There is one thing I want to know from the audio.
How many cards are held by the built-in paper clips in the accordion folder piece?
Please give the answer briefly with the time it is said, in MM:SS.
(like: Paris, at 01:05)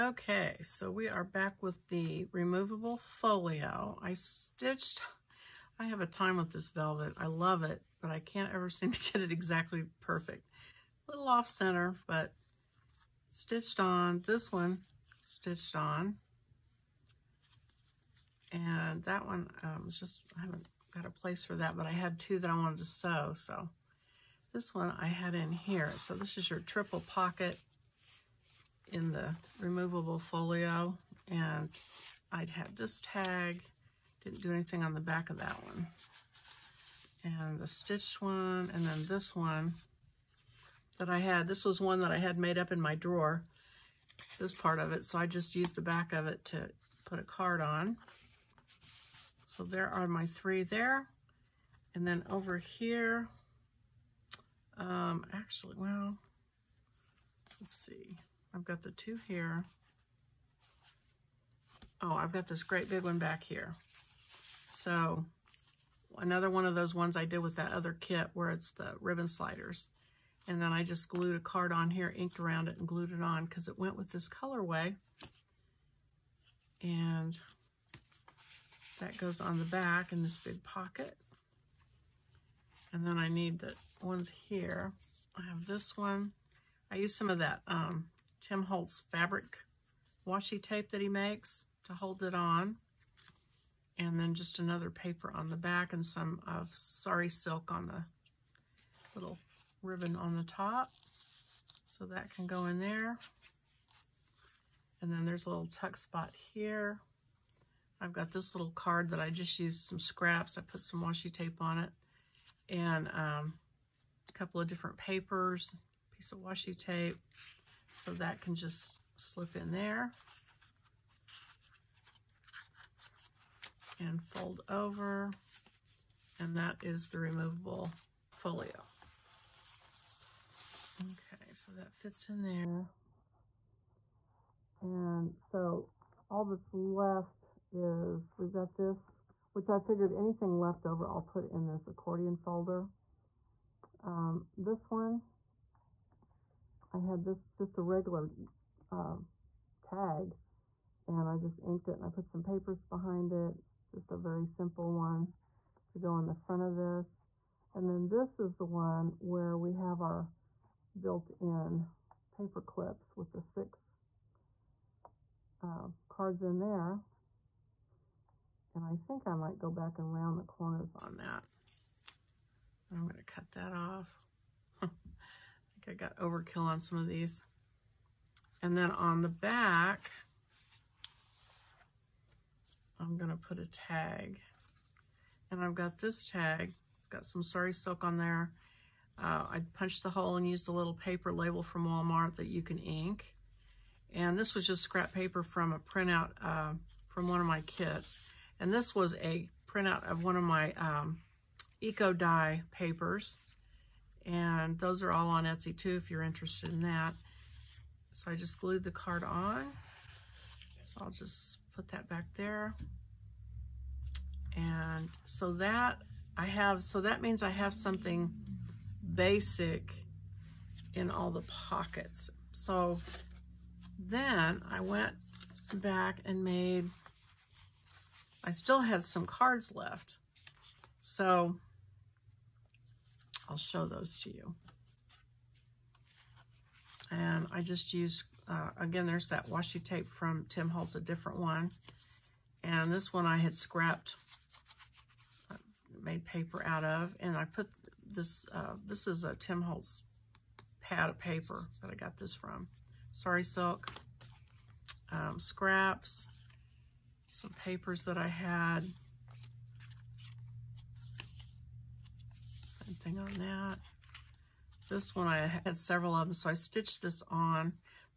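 6, at 02:43.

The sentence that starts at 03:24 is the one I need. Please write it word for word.
And those are all on Etsy too if you're interested in that.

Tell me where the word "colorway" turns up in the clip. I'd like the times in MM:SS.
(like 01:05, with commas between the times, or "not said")
01:14.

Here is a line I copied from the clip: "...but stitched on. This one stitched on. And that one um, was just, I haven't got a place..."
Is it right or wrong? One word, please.
right.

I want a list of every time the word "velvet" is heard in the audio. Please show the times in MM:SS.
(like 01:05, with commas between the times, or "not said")
00:06.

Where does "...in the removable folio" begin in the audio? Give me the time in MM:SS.
00:28.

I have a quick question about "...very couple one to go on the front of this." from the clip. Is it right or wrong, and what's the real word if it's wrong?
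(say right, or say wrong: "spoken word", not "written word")
wrong: "simple", not "couple".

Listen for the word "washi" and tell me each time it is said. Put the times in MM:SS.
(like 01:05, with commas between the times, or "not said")
01:30, 01:51, 01:56, 03:59.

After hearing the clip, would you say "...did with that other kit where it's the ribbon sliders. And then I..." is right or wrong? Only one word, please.
right.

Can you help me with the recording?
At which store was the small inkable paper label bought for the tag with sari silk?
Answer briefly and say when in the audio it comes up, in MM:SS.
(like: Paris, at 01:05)
Walmart, at 03:11.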